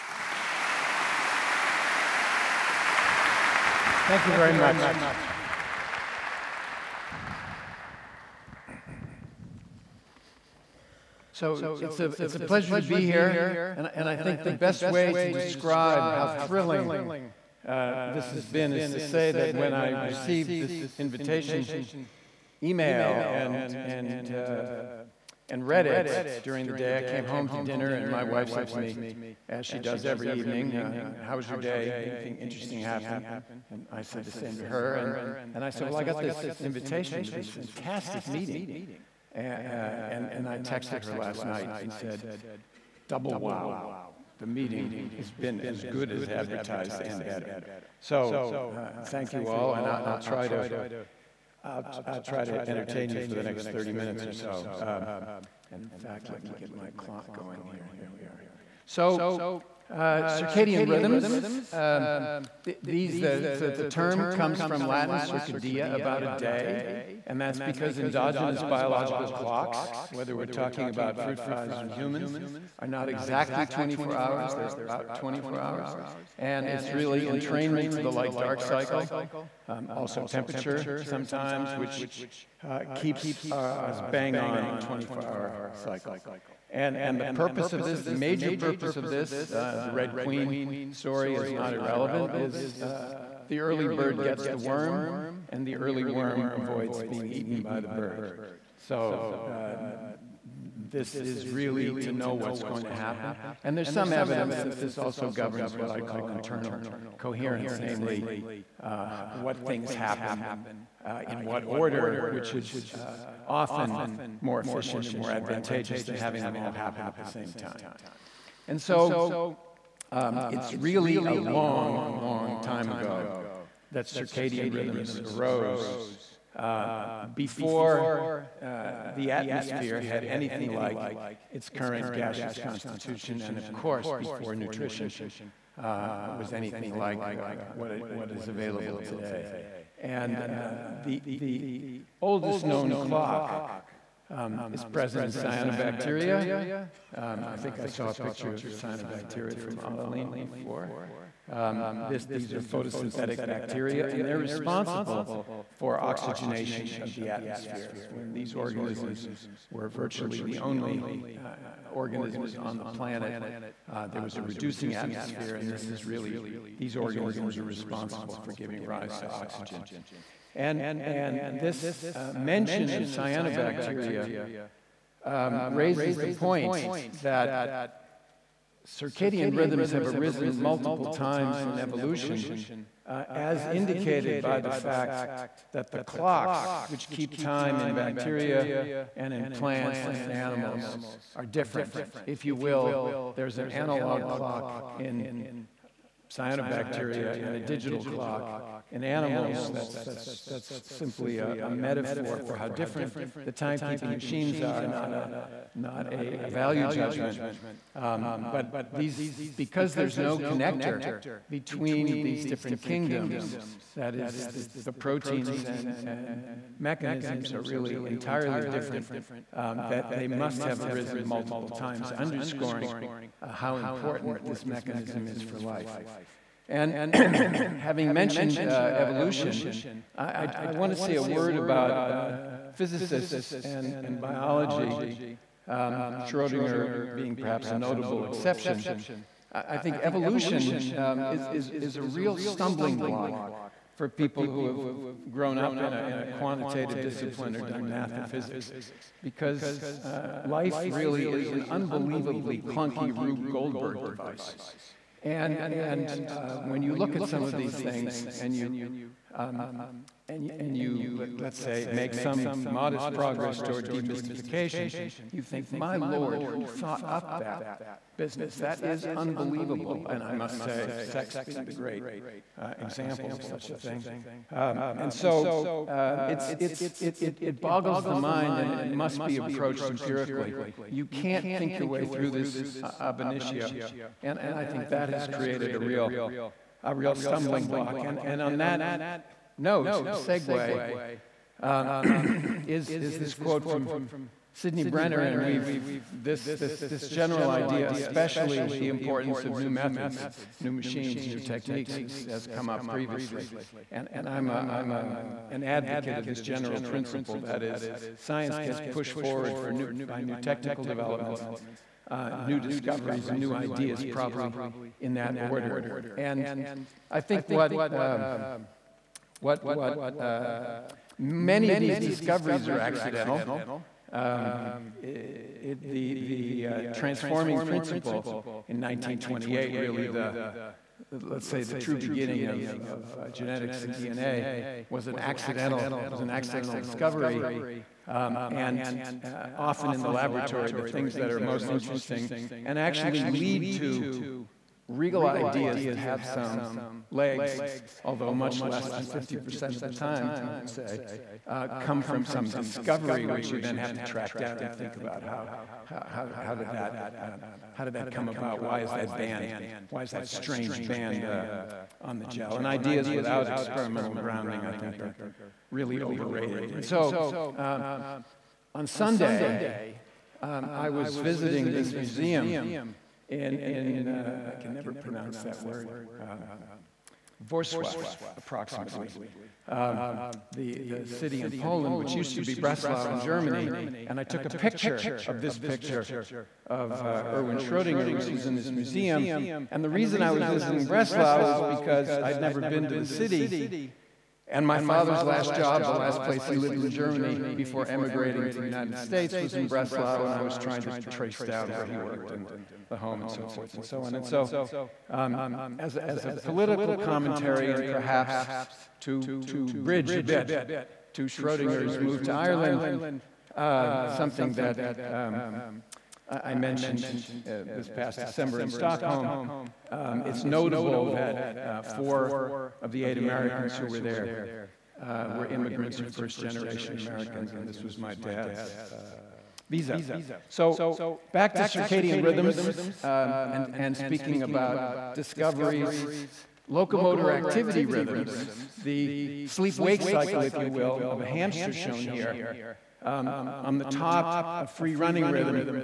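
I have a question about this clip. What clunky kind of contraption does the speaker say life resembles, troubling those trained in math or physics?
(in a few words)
Rube Goldberg device.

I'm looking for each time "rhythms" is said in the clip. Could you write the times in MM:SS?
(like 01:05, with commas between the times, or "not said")
01:00, 02:04, 02:59, 07:12, 07:17, 07:25.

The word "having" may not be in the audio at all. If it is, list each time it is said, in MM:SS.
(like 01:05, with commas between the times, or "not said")
01:56, 03:47.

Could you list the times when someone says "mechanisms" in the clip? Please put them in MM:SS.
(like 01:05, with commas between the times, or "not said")
03:36, 03:44.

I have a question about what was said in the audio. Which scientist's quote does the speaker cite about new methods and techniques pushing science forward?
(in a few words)
Sidney Brenner.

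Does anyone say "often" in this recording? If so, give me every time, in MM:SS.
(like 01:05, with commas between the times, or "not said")
01:53, 05:39.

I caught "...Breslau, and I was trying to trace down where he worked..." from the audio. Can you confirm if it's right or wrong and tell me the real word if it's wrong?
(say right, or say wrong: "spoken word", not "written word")
right.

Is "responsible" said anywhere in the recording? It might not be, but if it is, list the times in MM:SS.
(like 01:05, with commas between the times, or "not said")
02:34, 02:47.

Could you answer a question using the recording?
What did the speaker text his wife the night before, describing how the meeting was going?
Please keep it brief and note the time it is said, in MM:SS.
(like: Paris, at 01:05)
double wow, at 00:43.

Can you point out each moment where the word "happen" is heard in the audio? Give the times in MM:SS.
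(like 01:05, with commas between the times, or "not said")
00:32, 01:42, 01:49, 01:56.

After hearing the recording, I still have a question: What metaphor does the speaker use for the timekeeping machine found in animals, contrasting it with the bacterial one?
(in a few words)
digital clock.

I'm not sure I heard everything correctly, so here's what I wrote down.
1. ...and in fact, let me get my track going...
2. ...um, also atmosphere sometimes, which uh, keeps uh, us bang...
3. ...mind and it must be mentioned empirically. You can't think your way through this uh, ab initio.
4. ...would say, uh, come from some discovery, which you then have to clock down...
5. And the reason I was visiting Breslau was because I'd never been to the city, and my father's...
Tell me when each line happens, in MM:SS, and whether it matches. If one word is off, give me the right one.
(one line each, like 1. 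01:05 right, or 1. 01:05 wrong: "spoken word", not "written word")
1. 00:55 wrong: "clock", not "track"
2. 01:19 wrong: "temperature", not "atmosphere"
3. 04:38 wrong: "approached", not "mentioned"
4. 05:50 wrong: "track", not "clock"
5. 06:29 right.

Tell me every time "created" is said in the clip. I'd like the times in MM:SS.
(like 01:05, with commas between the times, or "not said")
04:45.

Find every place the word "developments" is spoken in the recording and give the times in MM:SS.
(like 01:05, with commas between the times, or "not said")
05:10.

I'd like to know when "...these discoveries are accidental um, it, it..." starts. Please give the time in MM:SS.
05:21.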